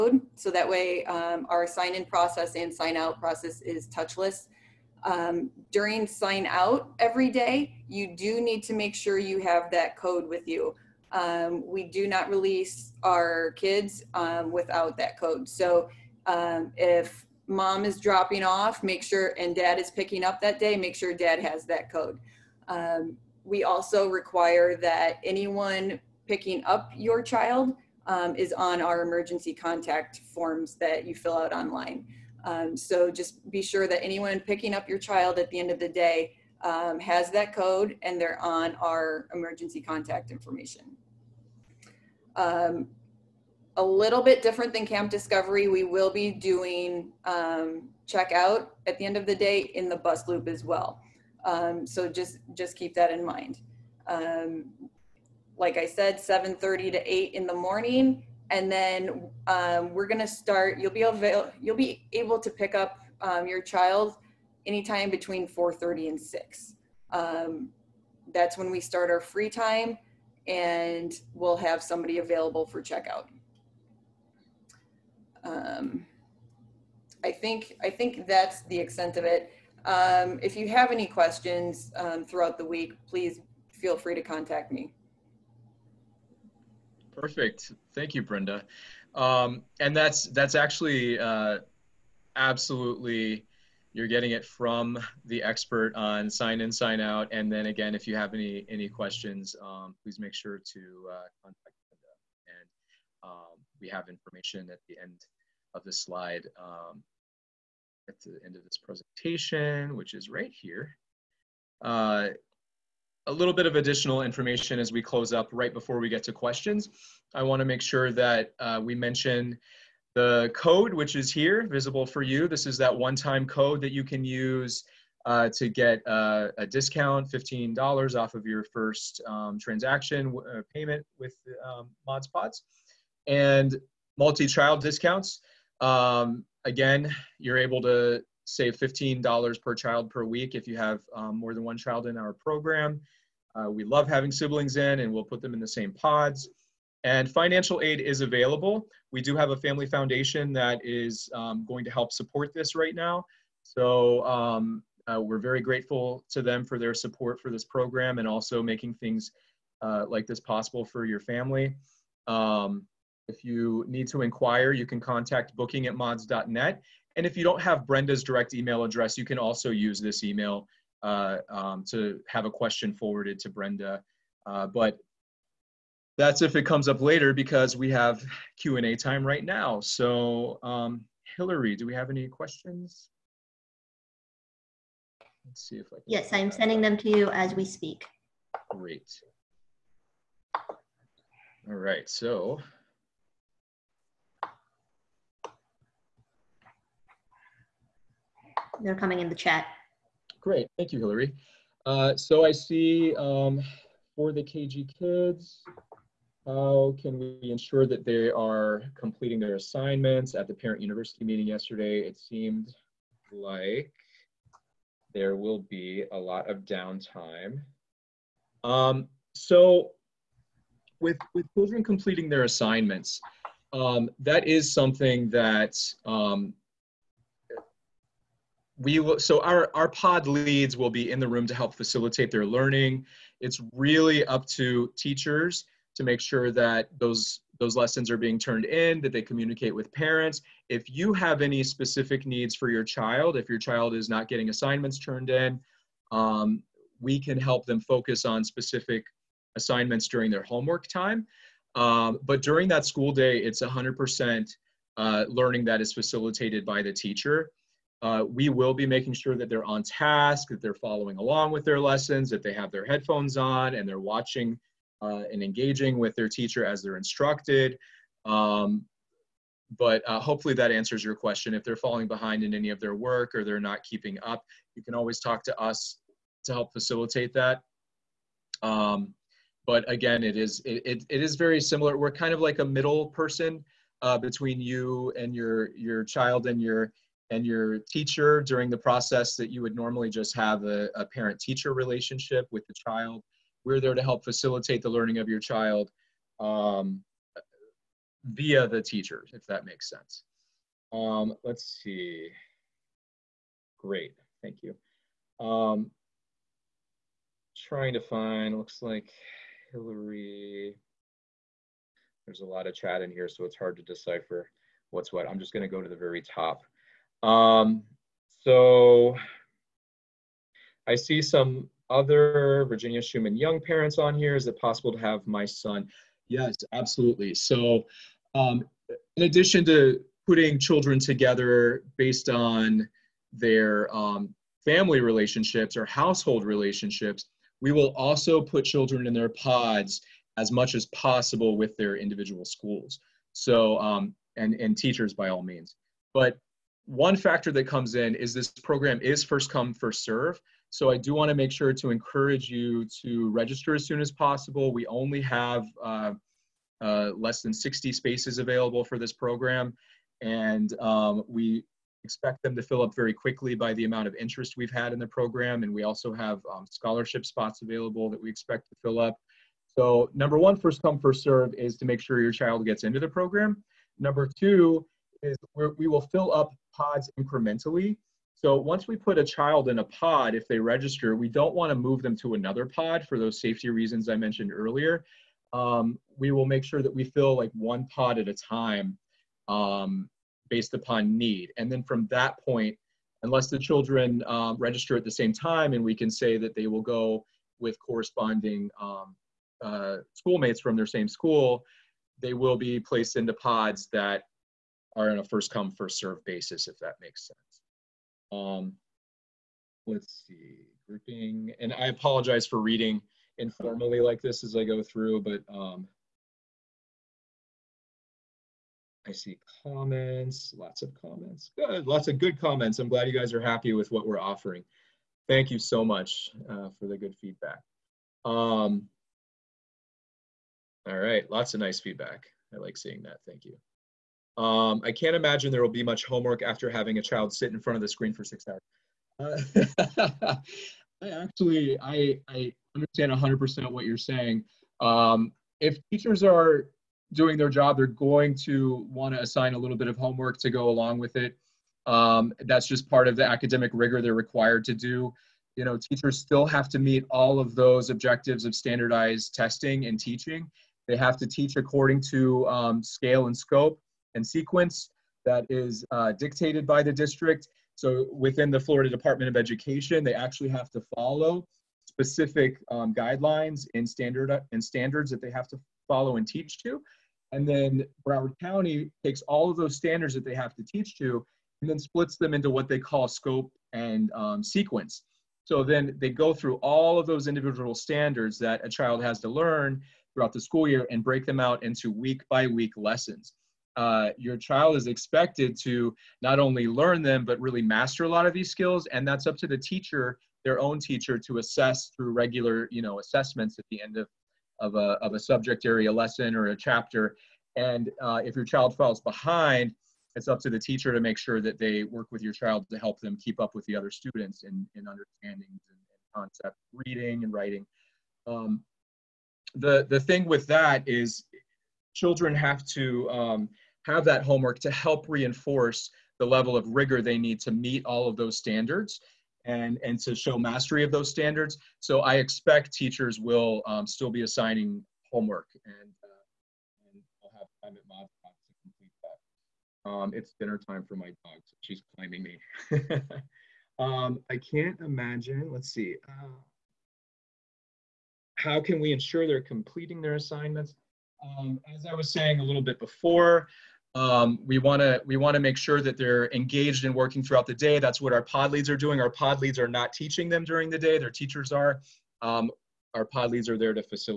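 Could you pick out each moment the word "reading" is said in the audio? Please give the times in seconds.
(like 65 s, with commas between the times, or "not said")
412 s, 516 s.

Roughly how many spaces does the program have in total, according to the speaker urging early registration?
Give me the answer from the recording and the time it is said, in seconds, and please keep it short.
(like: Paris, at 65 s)
Less than 60, at 357 s.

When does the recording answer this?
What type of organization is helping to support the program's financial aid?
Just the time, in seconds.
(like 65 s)
149 s.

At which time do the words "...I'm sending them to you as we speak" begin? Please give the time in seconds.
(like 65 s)
186 s.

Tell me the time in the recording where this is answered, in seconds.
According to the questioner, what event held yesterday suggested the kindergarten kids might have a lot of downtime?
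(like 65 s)
210 s.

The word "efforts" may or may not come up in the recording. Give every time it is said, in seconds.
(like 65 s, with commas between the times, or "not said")
not said.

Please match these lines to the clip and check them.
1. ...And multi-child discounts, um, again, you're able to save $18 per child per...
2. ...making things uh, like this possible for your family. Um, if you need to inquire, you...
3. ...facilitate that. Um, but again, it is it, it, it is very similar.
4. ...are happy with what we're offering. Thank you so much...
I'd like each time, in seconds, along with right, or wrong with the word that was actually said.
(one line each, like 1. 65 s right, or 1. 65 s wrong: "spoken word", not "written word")
1. 133 s wrong: "15", not "18"
2. 158 s right
3. 276 s right
4. 423 s right.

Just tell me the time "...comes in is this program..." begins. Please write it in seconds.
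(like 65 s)
347 s.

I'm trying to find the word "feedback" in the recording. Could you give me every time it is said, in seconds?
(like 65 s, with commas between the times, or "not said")
427 s, 431 s.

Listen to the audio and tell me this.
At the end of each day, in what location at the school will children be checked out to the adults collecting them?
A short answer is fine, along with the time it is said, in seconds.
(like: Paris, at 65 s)
Bus loop, at 49 s.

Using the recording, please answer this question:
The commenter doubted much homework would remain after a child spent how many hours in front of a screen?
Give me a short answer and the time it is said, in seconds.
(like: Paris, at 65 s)
6, at 438 s.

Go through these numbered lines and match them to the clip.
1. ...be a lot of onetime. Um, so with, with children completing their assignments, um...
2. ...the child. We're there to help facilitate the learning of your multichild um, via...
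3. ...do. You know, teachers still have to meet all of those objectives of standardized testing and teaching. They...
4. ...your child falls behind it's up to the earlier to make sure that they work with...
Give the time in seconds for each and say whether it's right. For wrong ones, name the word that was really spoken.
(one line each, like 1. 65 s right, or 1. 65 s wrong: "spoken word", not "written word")
1. 215 s wrong: "downtime", not "onetime"
2. 292 s wrong: "child", not "multichild"
3. 454 s right
4. 508 s wrong: "teacher", not "earlier".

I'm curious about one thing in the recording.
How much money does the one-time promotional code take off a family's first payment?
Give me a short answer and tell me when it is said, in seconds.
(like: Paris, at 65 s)
$15, at 127 s.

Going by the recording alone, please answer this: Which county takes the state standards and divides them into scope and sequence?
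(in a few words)
Broward County.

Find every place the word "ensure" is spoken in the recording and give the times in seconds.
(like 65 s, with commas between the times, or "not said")
207 s, 548 s.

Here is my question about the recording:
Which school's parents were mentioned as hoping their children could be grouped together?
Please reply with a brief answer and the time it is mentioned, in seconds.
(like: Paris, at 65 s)
Virginia Shuman Young, at 322 s.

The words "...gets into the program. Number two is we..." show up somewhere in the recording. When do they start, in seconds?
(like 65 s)
372 s.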